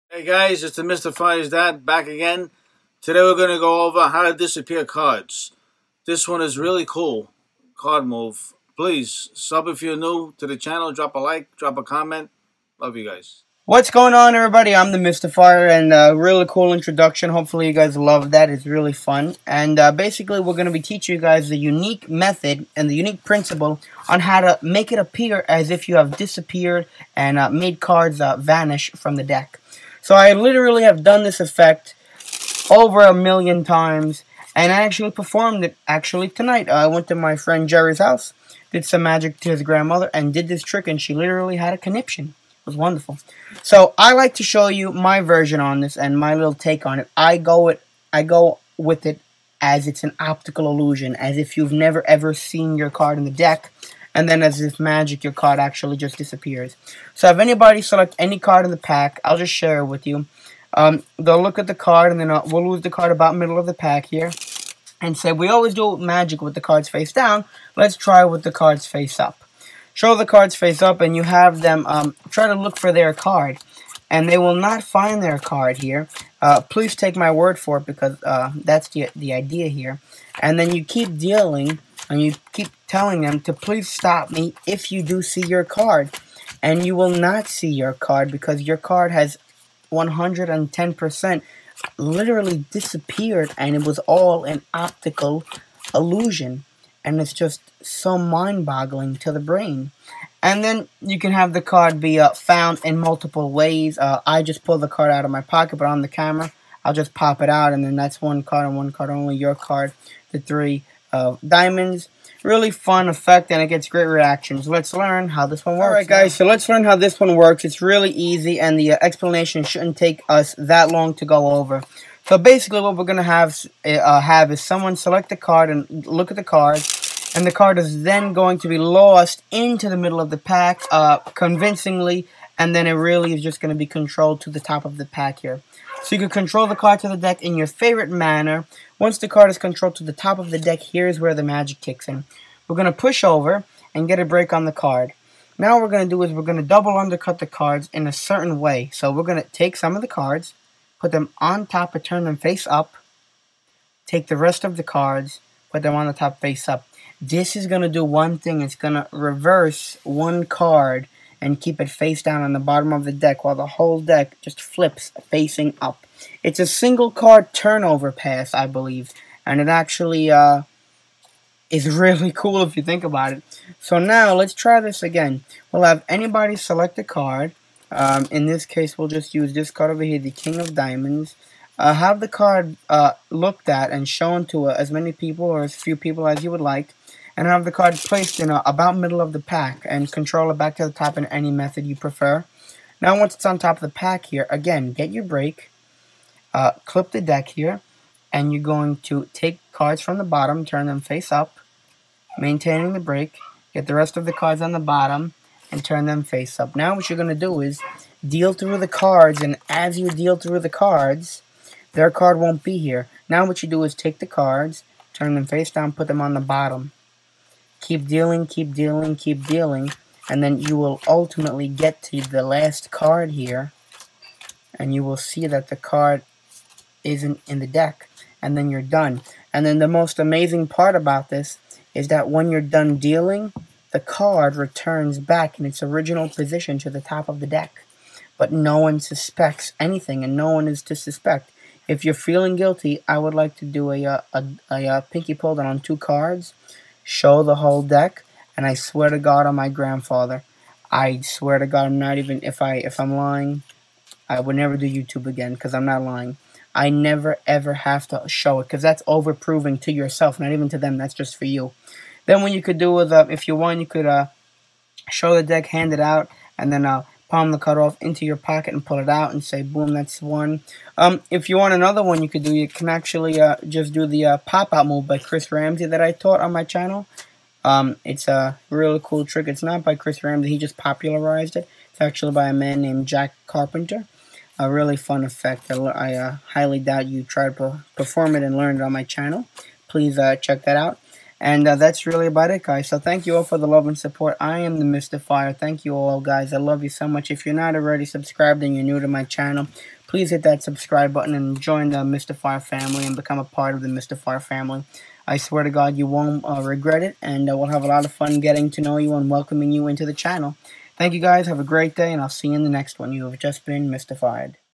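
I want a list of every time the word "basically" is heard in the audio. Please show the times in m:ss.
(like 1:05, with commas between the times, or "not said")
0:19, 2:02.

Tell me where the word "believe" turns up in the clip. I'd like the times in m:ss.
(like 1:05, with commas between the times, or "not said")
2:48.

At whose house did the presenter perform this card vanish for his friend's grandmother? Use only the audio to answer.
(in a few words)
Jerry's.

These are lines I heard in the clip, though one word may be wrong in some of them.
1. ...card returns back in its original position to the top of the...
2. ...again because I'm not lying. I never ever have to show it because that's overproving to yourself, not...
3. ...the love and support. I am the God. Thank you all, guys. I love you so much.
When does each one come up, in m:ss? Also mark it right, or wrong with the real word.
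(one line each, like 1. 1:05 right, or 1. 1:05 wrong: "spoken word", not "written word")
1. 3:53 right
2. 4:15 right
3. 4:53 wrong: "Mystefyer", not "God".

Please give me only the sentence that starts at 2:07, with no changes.
And the card is then going to be lost into the middle of the pack uh, convincingly.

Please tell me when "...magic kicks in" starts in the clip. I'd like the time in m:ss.
2:21.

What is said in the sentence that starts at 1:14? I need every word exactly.
And they will not find their card here.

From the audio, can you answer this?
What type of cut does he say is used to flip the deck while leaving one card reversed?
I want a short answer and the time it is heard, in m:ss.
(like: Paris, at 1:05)
Double undercut, at 2:26.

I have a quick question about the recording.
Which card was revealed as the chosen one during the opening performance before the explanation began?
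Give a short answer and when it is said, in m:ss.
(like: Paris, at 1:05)
Three of diamonds, at 1:50.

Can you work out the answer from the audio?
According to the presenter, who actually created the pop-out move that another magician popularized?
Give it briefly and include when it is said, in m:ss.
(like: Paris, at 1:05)
Jack Carpenter, at 4:43.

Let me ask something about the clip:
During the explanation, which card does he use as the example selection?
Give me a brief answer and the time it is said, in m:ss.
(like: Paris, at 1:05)
King of Diamonds, at 3:00.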